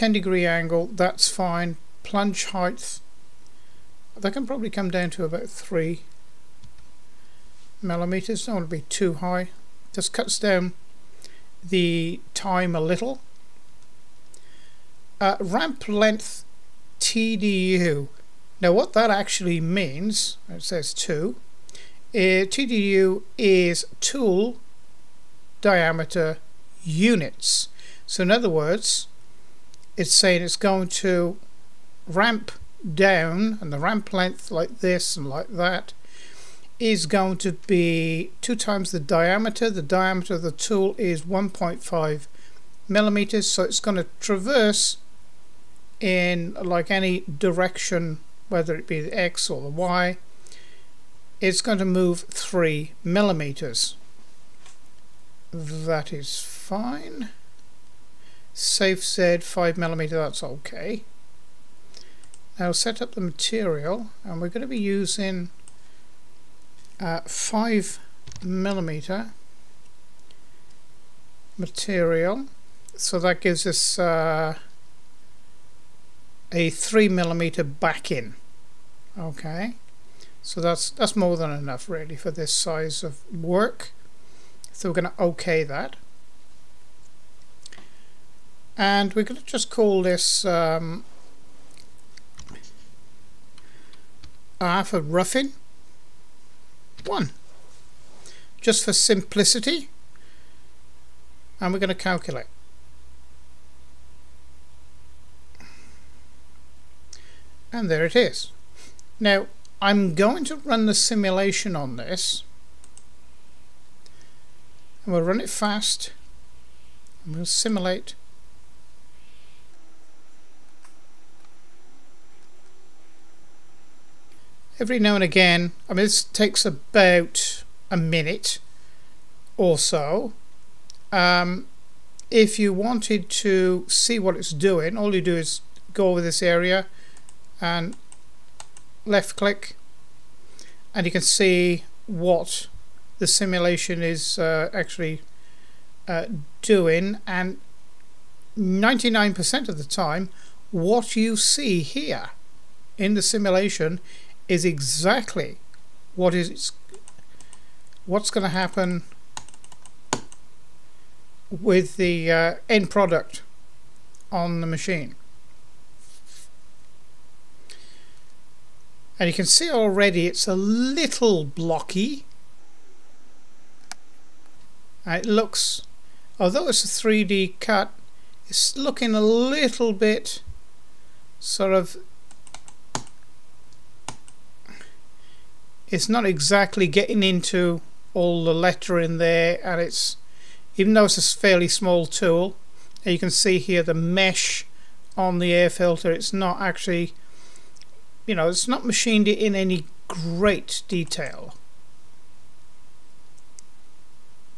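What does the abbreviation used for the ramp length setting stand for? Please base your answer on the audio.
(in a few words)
tool diameter units.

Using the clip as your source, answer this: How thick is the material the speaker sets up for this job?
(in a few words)
5 millimeter.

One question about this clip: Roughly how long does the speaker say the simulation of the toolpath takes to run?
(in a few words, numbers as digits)
about a minute.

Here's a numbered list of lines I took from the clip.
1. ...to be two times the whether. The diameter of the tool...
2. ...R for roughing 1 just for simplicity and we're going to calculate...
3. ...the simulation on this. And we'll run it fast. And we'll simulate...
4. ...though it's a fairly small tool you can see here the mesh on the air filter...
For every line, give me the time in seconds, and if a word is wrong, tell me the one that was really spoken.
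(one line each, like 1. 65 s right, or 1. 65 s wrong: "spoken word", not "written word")
1. 37 s wrong: "diameter", not "whether"
2. 94 s right
3. 110 s right
4. 190 s right.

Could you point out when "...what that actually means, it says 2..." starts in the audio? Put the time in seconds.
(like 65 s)
18 s.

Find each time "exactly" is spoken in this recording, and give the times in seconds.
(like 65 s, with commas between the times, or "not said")
154 s, 186 s.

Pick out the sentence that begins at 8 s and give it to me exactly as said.
Don't want to be too high.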